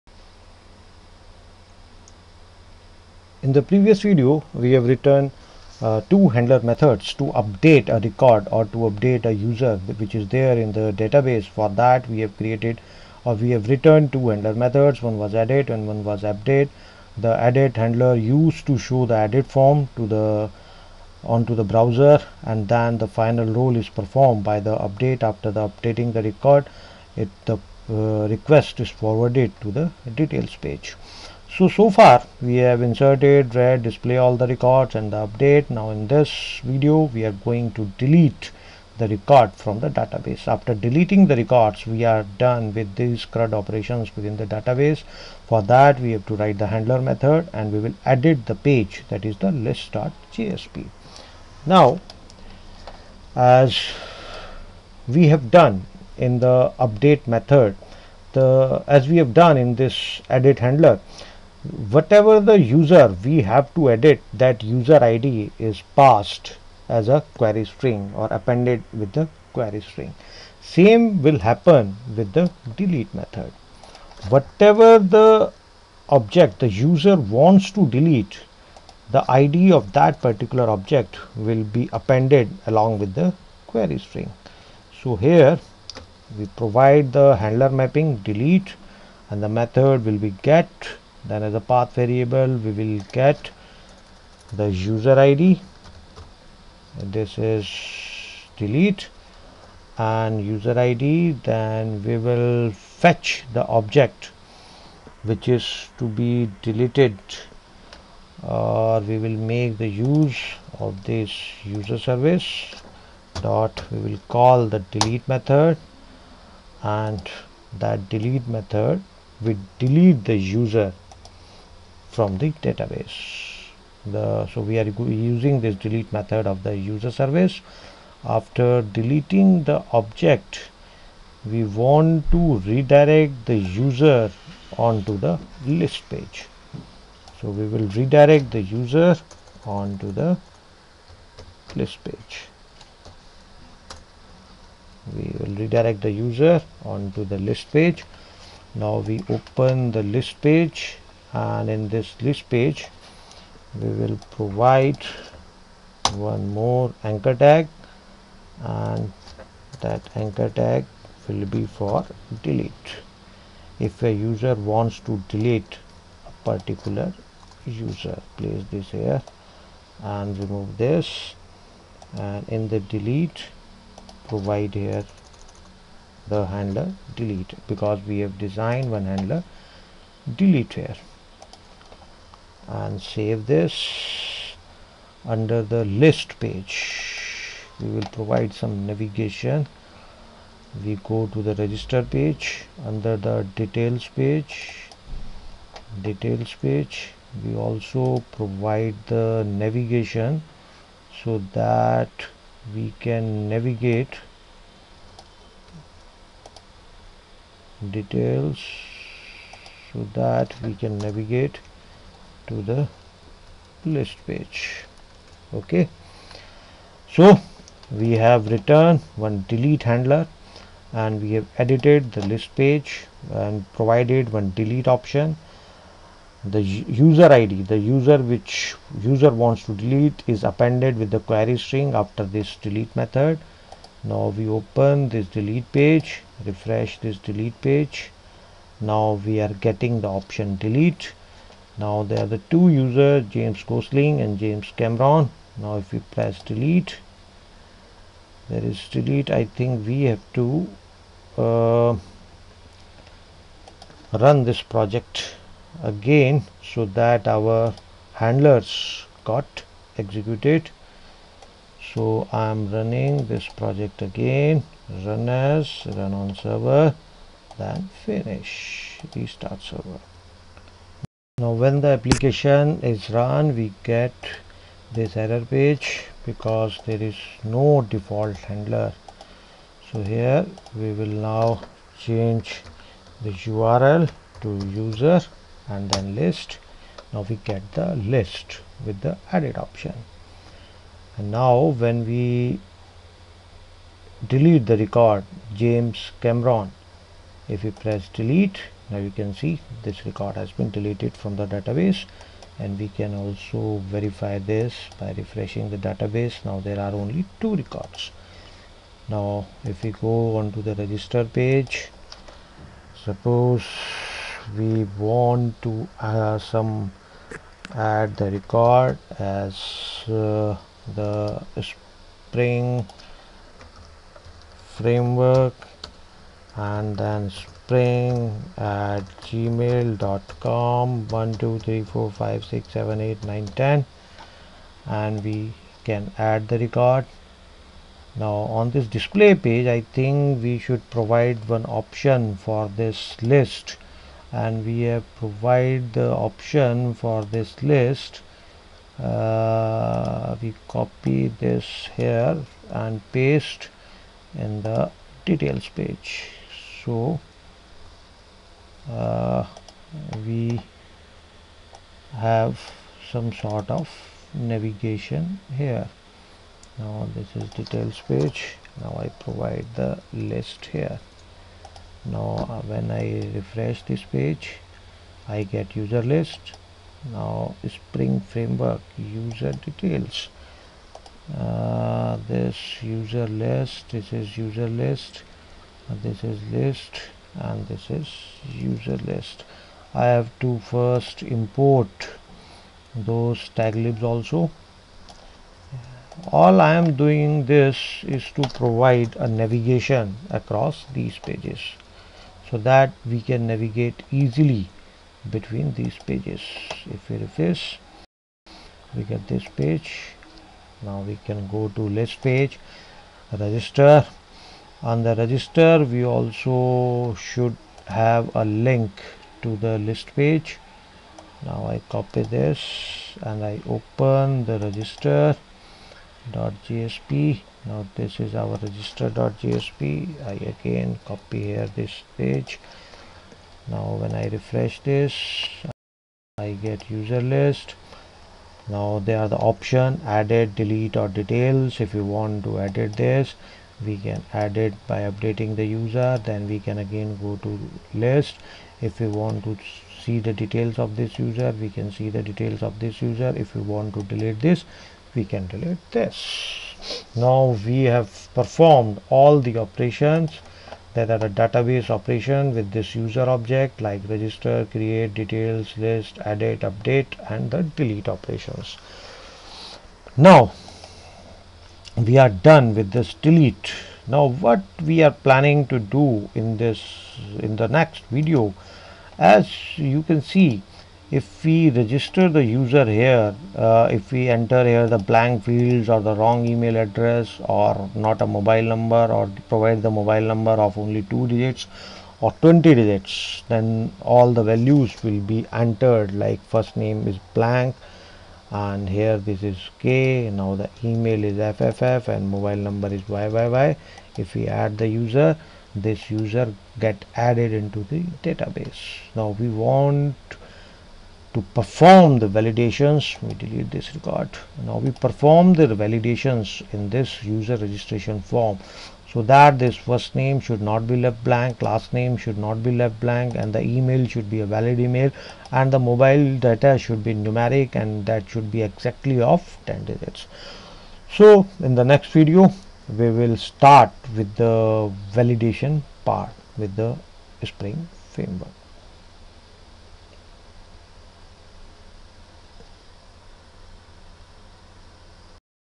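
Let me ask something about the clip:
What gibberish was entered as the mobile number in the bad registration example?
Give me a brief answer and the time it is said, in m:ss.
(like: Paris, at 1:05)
yyy, at 8:23.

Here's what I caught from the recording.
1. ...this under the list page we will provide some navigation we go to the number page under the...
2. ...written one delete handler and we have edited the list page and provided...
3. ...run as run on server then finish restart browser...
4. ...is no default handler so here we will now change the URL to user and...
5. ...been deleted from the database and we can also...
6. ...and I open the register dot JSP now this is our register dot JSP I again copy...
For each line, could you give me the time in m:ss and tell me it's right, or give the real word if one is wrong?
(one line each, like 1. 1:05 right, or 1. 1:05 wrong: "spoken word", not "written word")
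1. 3:03 wrong: "register", not "number"
2. 3:38 right
3. 4:25 wrong: "server", not "browser"
4. 4:37 right
5. 5:00 right
6. 7:03 right.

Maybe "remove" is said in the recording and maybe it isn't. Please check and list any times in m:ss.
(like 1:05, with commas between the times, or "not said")
2:50.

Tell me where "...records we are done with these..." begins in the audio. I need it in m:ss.
0:41.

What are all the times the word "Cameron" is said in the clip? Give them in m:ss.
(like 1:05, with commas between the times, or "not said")
4:04, 4:56.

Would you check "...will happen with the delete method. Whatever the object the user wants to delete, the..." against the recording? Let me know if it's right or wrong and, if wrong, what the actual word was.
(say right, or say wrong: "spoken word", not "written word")
right.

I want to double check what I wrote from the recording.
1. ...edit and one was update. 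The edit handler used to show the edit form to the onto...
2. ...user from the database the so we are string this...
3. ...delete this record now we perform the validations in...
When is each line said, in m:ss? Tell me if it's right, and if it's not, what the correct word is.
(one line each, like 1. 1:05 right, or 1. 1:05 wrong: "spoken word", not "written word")
1. 0:15 right
2. 2:00 wrong: "using", not "string"
3. 8:33 right.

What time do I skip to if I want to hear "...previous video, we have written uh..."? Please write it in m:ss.
0:03.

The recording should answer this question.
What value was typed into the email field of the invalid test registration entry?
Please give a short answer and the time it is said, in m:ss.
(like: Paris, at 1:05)
fff, at 8:21.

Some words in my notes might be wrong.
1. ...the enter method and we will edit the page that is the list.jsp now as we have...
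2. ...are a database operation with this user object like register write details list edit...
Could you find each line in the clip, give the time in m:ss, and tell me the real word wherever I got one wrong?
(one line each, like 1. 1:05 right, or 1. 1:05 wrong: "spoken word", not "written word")
1. 0:46 wrong: "handler", not "enter"
2. 7:41 wrong: "create", not "write".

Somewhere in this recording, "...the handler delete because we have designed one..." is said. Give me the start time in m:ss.
2:56.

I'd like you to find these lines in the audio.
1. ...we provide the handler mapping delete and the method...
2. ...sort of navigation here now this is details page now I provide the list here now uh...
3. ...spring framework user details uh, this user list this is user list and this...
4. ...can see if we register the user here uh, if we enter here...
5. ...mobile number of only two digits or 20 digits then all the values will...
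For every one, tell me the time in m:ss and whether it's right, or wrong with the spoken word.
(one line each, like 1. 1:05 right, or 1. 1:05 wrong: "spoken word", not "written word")
1. 1:26 right
2. 6:03 right
3. 6:17 right
4. 8:00 right
5. 8:09 right.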